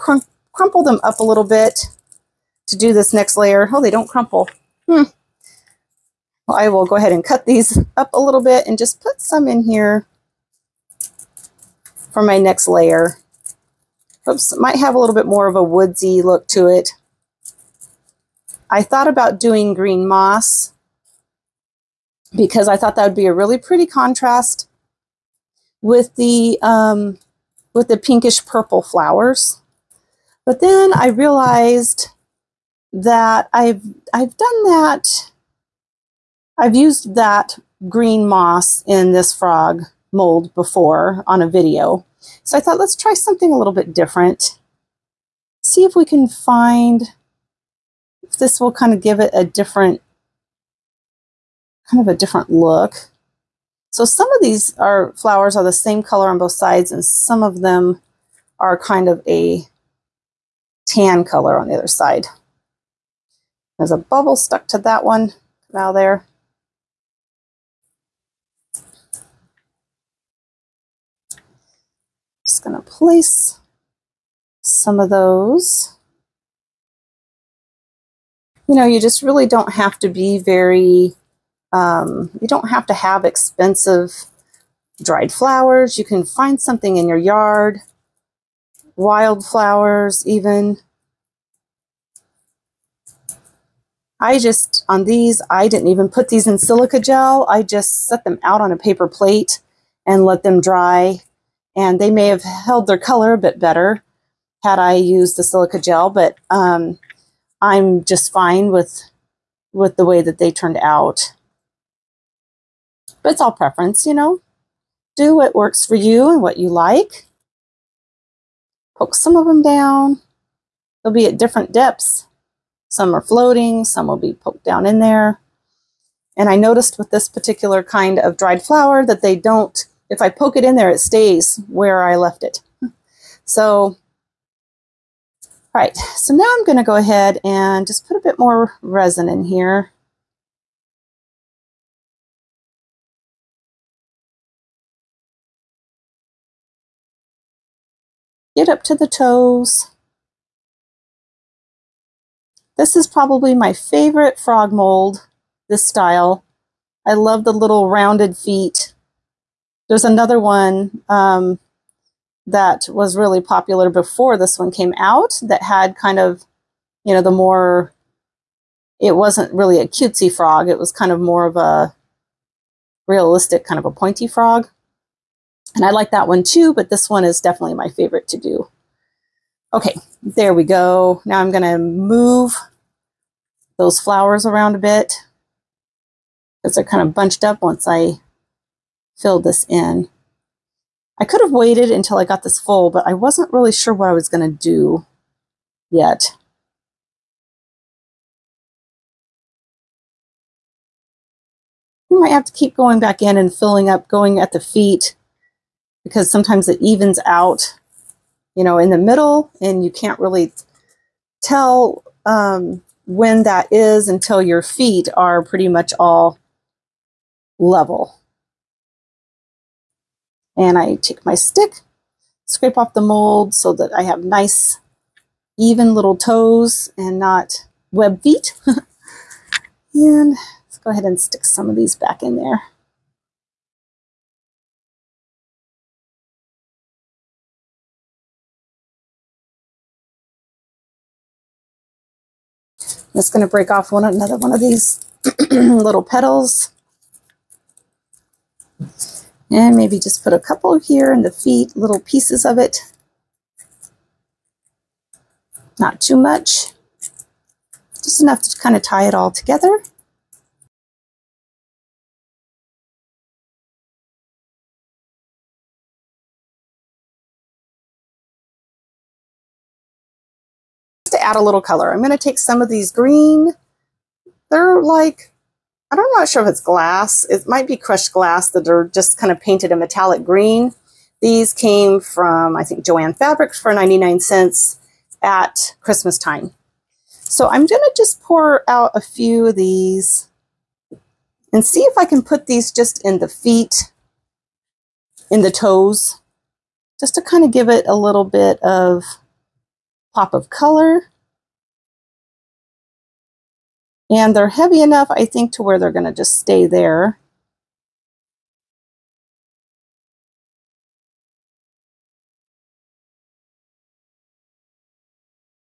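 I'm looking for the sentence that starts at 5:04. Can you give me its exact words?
And they're heavy enough, I think, to where they're going to just stay there.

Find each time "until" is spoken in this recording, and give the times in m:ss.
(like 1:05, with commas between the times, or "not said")
3:11, 3:34.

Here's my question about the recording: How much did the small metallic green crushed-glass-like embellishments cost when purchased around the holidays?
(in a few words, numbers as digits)
99 cents.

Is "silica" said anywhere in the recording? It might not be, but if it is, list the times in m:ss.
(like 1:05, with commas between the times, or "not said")
1:36, 1:45.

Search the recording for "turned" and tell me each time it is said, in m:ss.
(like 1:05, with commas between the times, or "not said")
1:50.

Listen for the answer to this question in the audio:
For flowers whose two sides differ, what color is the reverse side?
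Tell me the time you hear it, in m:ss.
1:00.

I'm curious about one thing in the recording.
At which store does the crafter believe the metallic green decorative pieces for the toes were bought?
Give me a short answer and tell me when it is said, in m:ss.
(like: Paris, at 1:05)
Joann Fabrics, at 4:42.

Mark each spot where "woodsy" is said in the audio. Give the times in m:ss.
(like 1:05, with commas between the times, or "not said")
0:15.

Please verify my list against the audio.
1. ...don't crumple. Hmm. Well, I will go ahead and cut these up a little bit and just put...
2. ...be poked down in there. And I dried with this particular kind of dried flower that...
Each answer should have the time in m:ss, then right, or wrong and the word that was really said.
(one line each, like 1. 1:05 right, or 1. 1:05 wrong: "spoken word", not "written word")
1. 0:03 right
2. 2:04 wrong: "noticed", not "dried".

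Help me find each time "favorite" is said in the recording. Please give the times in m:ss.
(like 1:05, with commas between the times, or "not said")
2:33, 2:57.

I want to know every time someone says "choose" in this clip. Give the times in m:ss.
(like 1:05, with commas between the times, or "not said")
not said.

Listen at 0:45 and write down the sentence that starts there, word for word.
See if we can find if this will kind of give it a different, kind of a different look.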